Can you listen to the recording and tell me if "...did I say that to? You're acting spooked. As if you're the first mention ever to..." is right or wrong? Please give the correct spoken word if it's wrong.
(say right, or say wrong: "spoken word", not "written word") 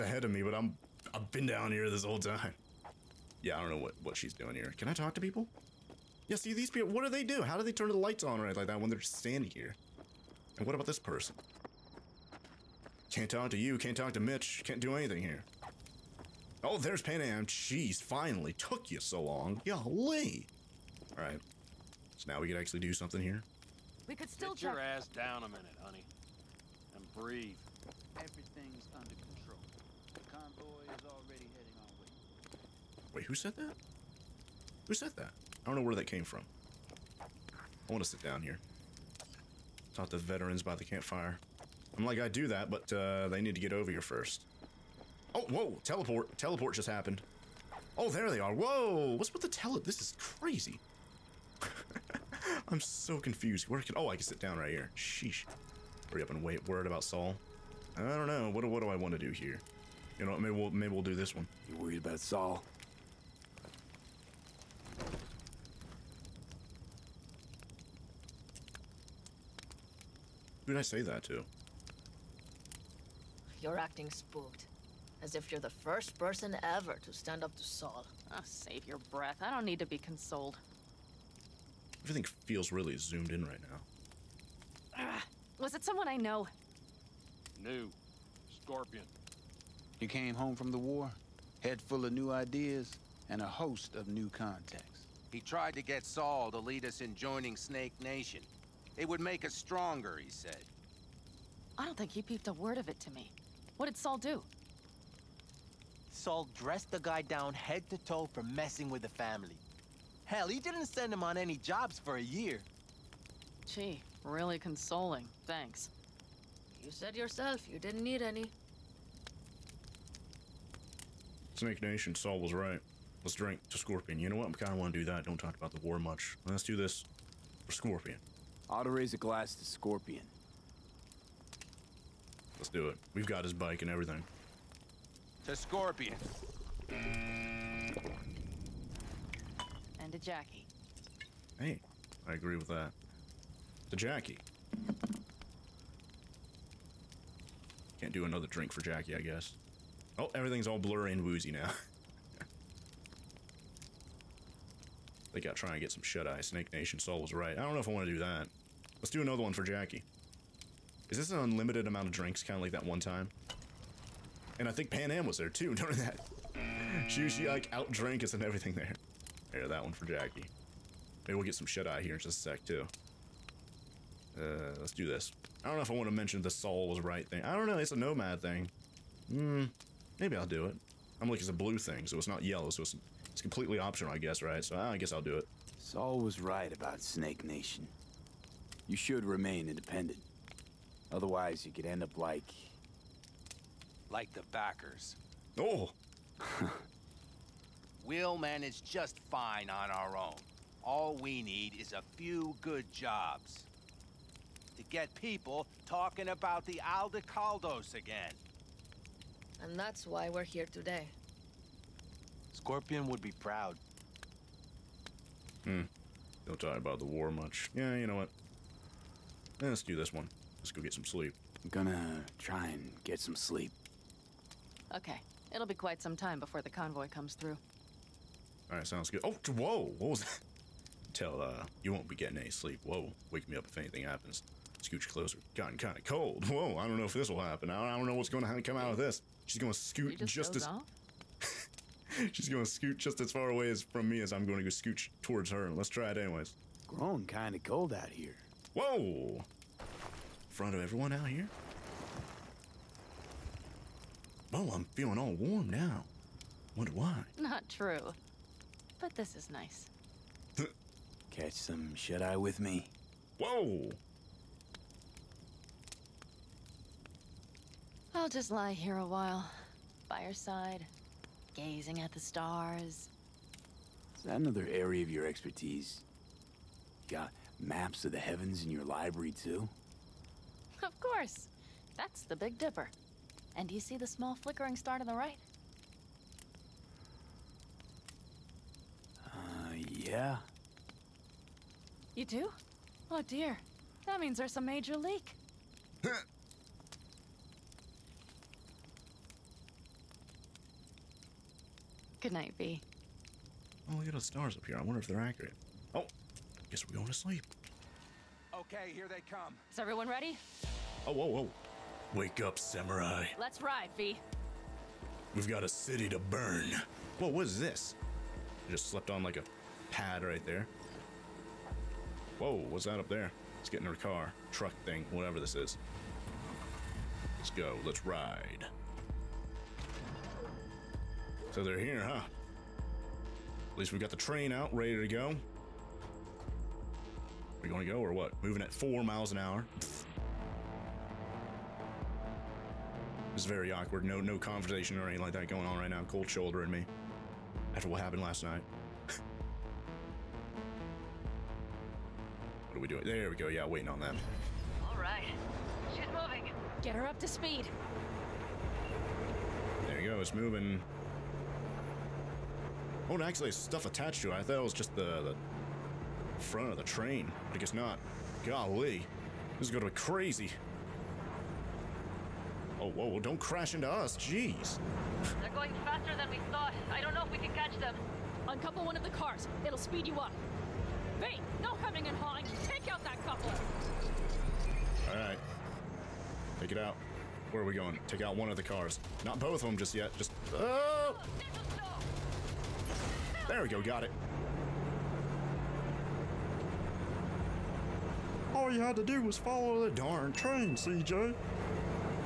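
wrong: "person", not "mention".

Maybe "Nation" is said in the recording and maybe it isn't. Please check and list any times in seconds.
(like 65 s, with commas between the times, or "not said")
97 s, 121 s, 156 s, 187 s.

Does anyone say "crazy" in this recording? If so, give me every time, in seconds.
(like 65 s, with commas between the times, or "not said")
50 s, 369 s.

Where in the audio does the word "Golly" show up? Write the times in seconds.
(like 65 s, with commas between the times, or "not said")
19 s, 368 s.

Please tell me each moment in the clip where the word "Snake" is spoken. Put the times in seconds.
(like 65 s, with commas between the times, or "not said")
97 s, 121 s, 156 s, 186 s.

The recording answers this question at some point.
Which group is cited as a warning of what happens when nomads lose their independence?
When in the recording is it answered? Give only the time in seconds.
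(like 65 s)
194 s.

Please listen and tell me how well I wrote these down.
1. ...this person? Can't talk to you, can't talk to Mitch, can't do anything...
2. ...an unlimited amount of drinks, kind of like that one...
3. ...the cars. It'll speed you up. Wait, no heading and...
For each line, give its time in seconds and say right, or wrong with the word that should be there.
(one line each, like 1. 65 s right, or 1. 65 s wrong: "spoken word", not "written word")
1. 10 s right
2. 161 s right
3. 379 s wrong: "hemming", not "heading".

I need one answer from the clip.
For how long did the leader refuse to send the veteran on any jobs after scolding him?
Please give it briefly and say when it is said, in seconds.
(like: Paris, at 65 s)
a year, at 112 s.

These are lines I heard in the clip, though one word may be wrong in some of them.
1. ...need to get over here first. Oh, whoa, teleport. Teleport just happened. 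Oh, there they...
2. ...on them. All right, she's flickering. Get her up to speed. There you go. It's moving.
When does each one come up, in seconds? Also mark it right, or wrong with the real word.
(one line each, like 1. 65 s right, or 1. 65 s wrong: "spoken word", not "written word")
1. 43 s right
2. 353 s wrong: "moving", not "flickering".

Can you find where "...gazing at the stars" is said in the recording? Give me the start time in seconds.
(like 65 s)
271 s.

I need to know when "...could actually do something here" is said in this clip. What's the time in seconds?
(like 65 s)
22 s.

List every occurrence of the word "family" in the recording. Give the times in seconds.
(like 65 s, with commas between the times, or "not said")
109 s.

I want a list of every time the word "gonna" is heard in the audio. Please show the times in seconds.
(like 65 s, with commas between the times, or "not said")
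221 s, 242 s.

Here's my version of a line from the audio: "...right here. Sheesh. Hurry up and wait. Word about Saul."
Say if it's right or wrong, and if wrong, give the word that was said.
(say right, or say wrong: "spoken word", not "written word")
right.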